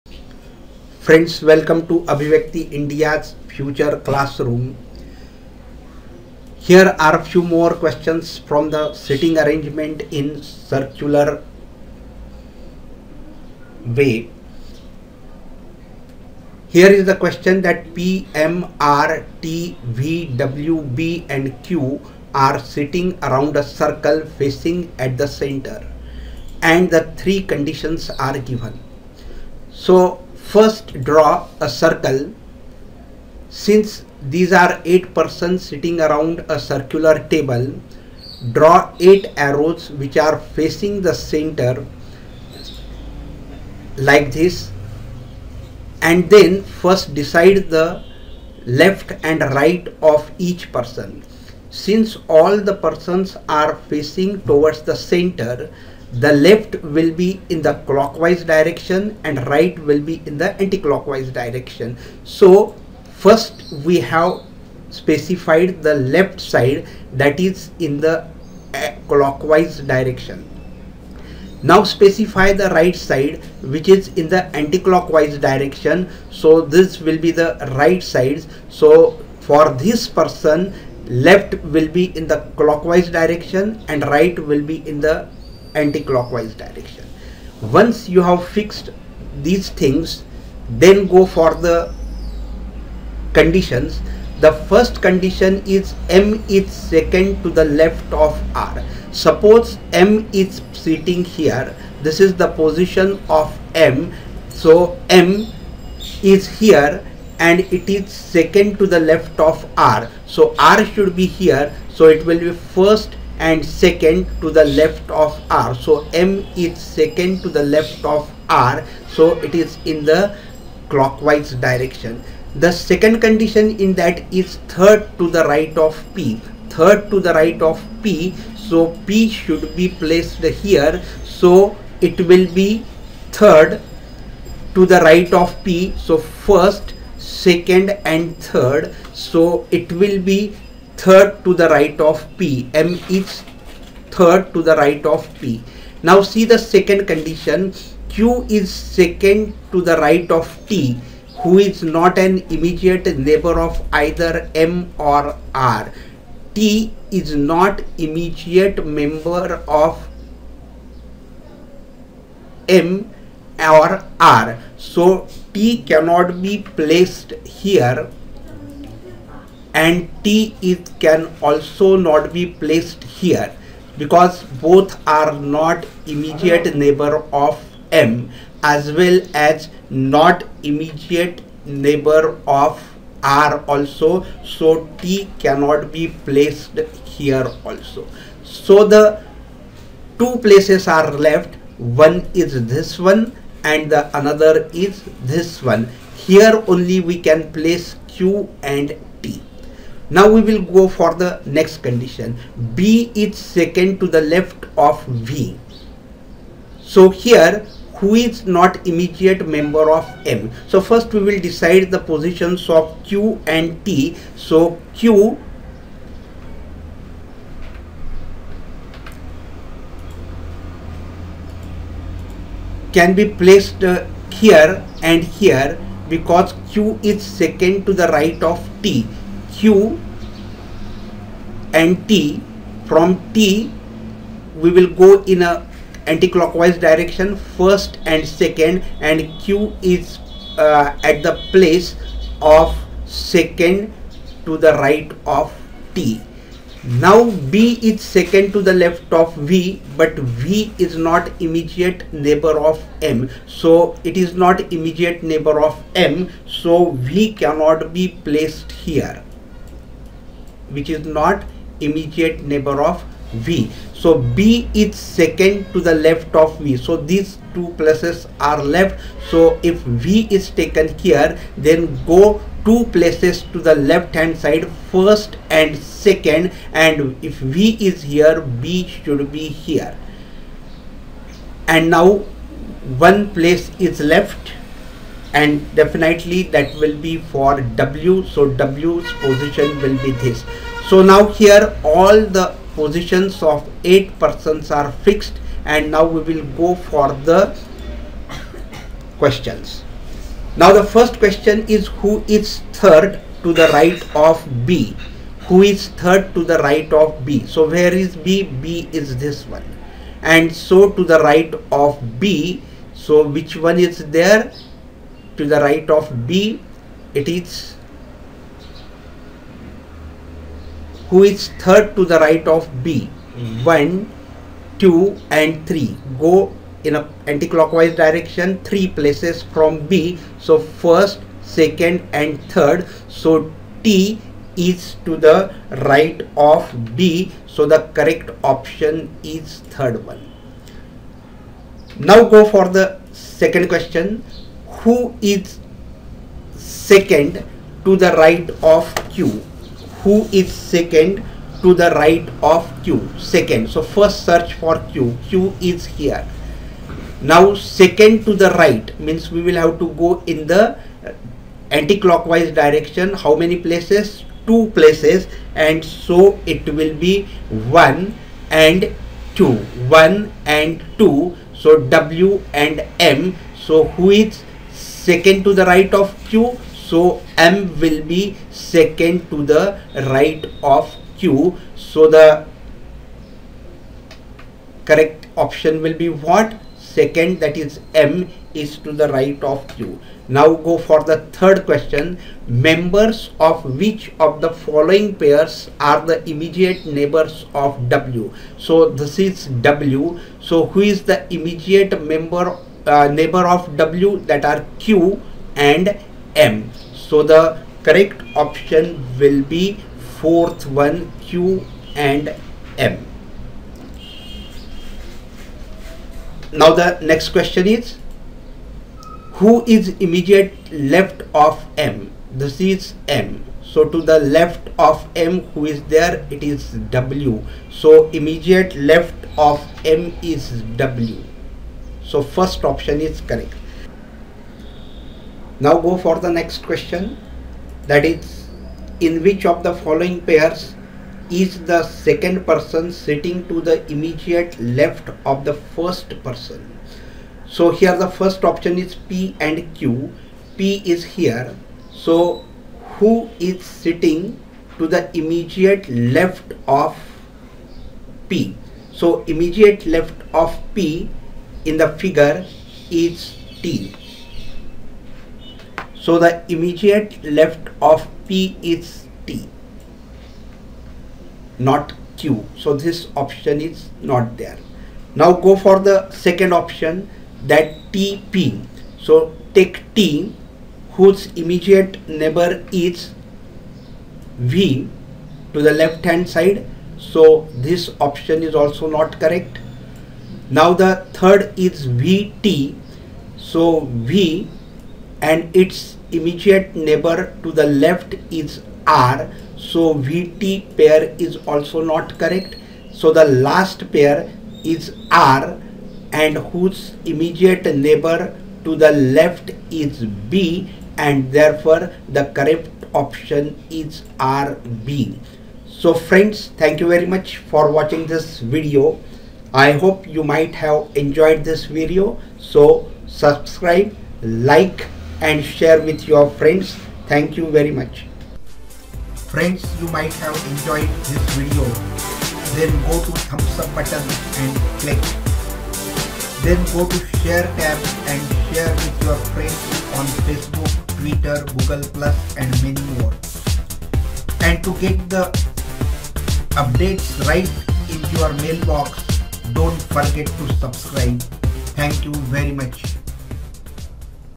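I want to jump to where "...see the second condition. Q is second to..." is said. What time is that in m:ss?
2:26.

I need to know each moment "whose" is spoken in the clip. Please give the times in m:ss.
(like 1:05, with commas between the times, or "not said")
8:00, 8:26.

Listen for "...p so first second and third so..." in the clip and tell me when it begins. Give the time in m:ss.
2:15.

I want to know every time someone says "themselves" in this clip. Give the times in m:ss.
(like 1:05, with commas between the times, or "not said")
not said.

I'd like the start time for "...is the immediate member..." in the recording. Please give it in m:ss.
6:40.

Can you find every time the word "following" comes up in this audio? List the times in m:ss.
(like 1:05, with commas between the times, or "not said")
6:34, 7:19.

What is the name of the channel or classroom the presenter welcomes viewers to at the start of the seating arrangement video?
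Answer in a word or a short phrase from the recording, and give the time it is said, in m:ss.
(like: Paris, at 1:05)
Abhivyakti India, at 0:02.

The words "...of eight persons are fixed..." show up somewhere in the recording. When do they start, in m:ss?
4:53.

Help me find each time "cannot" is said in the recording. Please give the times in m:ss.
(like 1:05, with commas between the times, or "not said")
2:45, 3:05, 4:17.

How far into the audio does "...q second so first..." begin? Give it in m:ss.
5:52.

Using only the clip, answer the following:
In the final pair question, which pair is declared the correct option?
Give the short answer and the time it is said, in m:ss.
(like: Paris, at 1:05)
RB, at 8:34.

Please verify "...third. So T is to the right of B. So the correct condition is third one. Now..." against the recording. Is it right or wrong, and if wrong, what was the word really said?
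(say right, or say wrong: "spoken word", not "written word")
wrong: "option", not "condition".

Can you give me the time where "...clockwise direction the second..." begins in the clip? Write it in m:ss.
2:00.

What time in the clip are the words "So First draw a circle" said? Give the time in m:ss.
0:29.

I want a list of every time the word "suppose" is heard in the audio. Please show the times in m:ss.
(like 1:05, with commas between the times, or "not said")
1:39.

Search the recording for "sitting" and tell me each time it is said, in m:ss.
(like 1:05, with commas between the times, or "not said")
0:08, 0:22, 0:35, 1:40, 7:22, 7:33.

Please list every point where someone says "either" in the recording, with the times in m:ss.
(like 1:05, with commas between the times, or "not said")
2:33.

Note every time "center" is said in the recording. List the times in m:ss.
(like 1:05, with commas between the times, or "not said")
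0:25, 0:41, 0:54.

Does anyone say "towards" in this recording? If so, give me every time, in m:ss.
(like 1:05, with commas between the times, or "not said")
0:54.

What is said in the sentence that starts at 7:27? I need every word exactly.
So here the first option is P and Q.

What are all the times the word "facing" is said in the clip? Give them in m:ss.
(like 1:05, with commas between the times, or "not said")
0:24, 0:40, 0:53.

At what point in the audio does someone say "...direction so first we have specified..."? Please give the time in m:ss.
1:01.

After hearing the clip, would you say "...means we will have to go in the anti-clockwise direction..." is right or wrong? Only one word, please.
right.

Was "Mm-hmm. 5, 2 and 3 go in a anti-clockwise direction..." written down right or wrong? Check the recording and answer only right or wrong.
wrong.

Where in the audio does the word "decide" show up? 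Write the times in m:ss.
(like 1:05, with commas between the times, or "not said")
0:47, 3:31.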